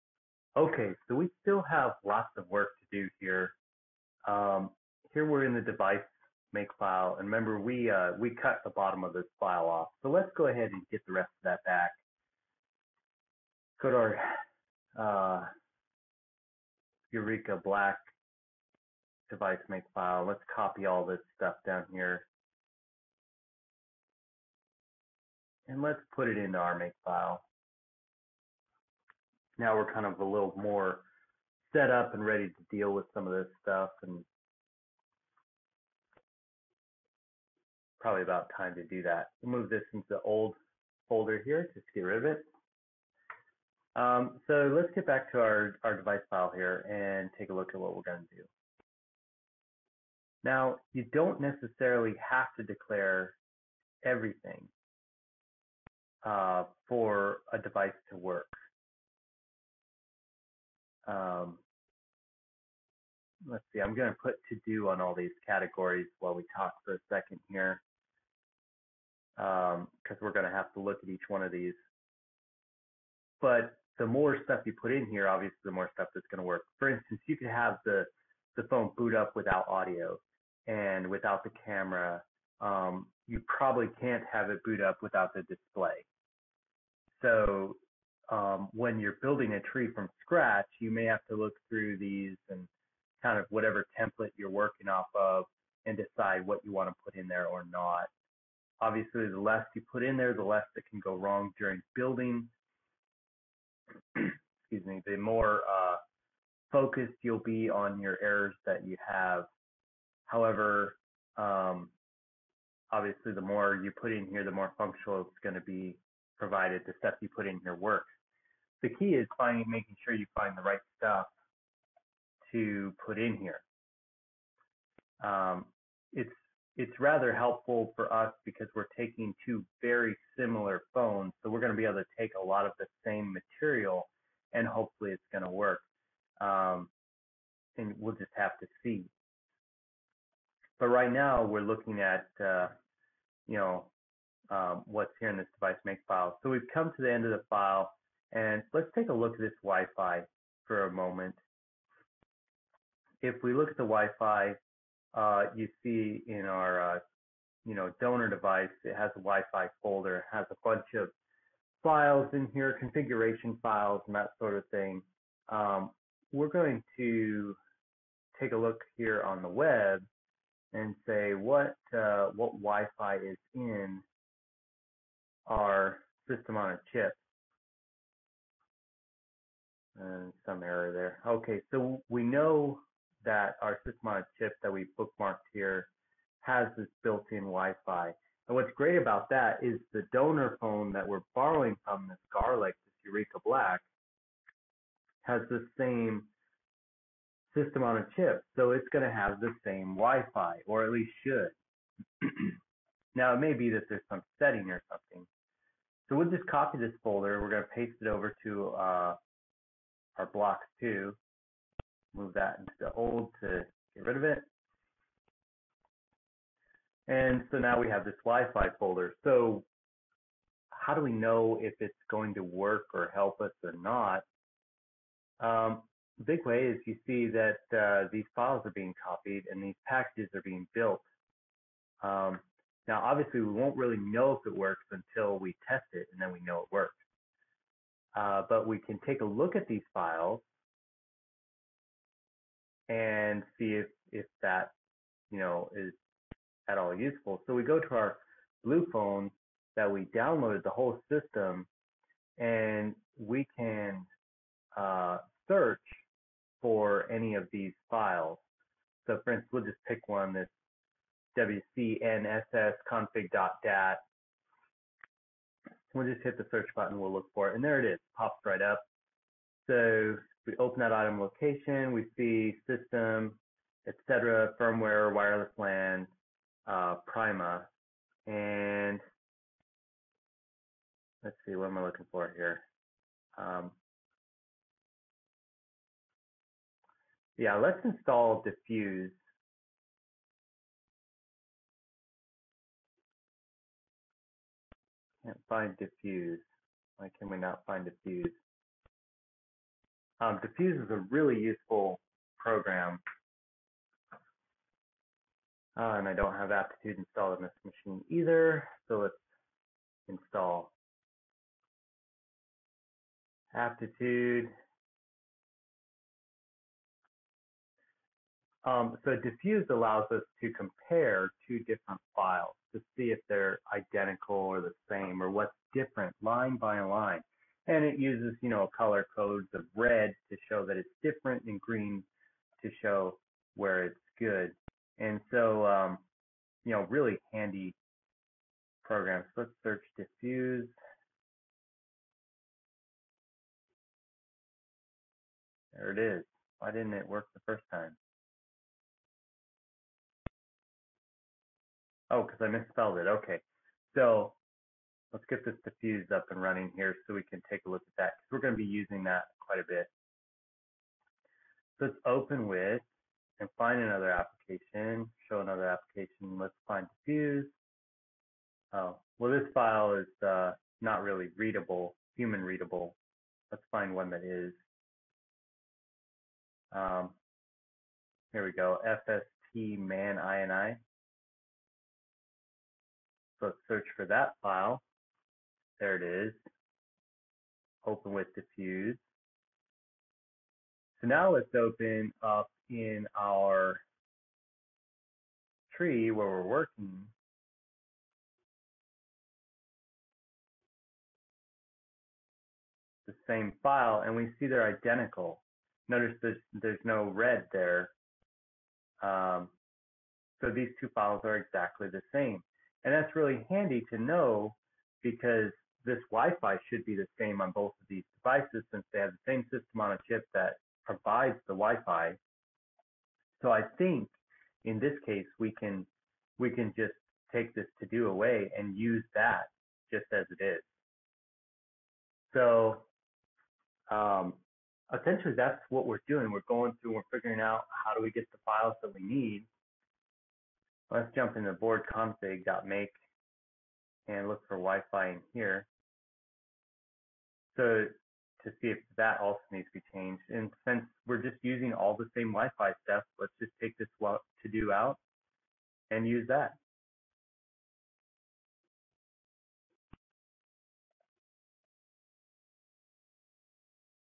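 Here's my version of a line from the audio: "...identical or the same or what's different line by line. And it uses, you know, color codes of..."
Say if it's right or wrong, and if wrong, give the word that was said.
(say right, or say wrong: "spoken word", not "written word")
right.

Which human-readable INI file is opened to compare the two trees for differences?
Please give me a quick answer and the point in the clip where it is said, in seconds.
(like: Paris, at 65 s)
FST man INI, at 378 s.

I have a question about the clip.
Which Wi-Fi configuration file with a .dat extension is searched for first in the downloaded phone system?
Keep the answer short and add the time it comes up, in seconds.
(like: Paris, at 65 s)
wcnssconfig.dat, at 261 s.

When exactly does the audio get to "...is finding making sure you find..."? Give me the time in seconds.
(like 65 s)
119 s.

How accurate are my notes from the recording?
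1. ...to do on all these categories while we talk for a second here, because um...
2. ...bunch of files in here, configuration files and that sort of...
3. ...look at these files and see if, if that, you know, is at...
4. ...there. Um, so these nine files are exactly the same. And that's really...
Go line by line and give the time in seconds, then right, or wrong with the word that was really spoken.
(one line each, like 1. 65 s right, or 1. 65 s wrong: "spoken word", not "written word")
1. 64 s right
2. 160 s right
3. 239 s right
4. 407 s wrong: "two", not "nine".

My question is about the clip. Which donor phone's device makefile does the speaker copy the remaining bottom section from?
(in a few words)
Yureka Black.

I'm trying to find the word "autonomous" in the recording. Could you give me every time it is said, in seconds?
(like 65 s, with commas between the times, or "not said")
not said.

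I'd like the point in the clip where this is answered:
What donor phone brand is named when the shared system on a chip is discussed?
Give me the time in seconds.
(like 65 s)
192 s.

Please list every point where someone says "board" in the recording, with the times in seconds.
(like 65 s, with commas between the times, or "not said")
441 s.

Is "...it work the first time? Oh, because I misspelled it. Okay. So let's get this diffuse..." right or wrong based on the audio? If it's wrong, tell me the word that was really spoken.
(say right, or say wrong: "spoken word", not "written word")
right.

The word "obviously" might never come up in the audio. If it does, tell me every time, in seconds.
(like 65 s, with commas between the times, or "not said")
75 s, 98 s, 112 s, 233 s.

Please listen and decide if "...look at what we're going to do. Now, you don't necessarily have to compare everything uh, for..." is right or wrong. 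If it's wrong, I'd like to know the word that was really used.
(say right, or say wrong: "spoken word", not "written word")
wrong: "declare", not "compare".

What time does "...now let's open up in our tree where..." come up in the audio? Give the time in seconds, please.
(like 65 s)
391 s.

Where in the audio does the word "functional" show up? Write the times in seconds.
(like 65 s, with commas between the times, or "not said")
114 s.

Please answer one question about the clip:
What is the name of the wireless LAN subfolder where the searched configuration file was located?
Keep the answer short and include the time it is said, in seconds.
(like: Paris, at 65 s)
Prima, at 277 s.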